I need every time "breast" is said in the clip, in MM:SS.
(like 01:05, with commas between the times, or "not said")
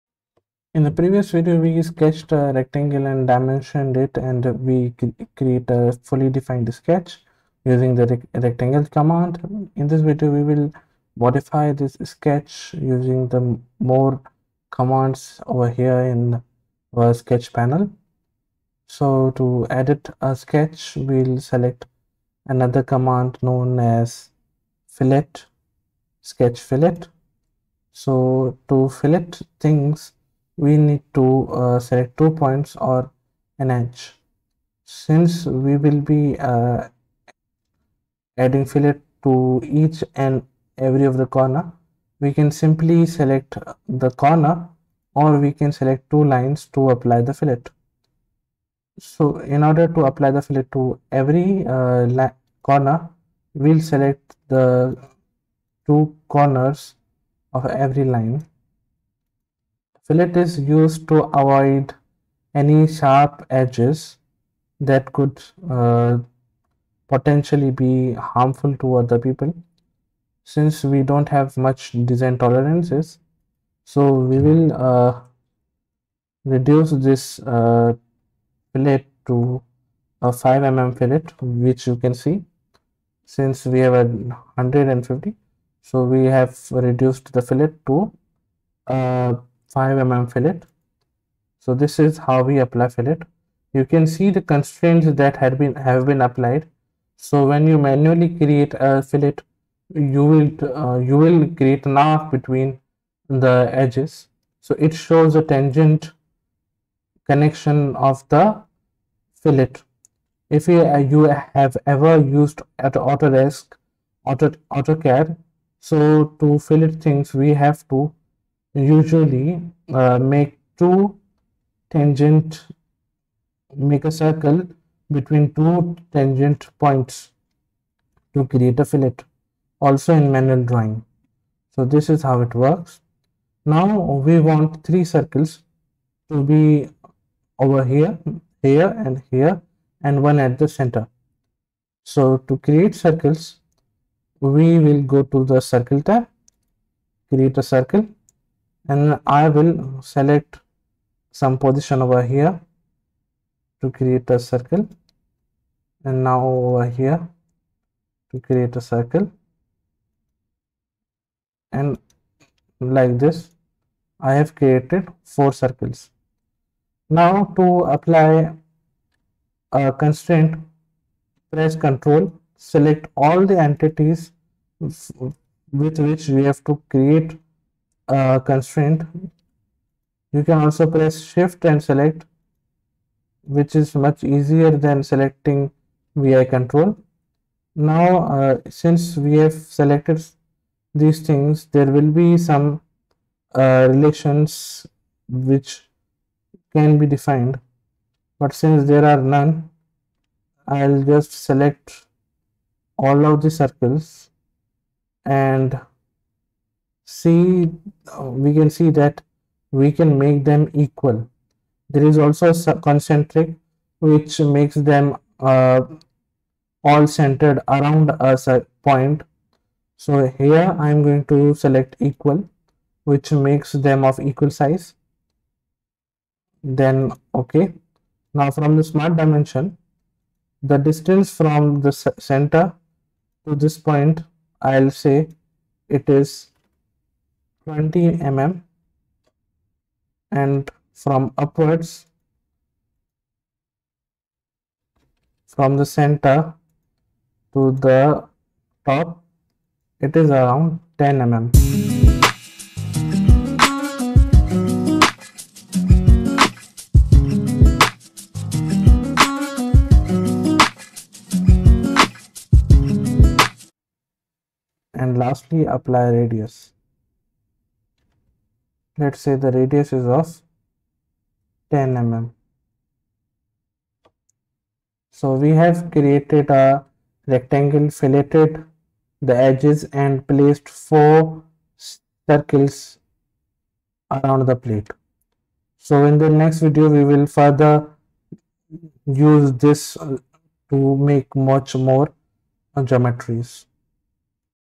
not said.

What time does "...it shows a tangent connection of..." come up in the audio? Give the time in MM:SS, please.
01:44.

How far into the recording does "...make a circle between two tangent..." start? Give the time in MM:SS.
02:03.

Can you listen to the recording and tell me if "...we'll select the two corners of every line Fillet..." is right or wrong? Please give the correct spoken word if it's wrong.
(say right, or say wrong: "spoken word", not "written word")
right.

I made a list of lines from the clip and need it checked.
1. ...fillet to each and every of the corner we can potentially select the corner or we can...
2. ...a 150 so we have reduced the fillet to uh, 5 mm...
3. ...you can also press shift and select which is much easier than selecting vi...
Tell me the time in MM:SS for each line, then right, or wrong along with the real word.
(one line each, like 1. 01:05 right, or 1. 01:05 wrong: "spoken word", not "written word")
1. 00:38 wrong: "simply", not "potentially"
2. 01:23 right
3. 03:00 right.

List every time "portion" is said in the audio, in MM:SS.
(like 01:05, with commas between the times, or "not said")
not said.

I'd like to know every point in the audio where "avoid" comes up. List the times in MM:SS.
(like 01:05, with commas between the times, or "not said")
01:01.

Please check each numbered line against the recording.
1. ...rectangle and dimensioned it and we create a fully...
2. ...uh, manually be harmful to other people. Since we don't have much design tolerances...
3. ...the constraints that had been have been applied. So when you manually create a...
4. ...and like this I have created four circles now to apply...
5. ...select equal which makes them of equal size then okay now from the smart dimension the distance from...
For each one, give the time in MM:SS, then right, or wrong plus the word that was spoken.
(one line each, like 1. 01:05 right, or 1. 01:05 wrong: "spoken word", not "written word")
1. 00:02 right
2. 01:05 wrong: "potentially", not "manually"
3. 01:34 right
4. 02:41 right
5. 03:41 right.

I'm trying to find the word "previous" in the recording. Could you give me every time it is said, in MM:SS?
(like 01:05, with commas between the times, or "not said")
00:00.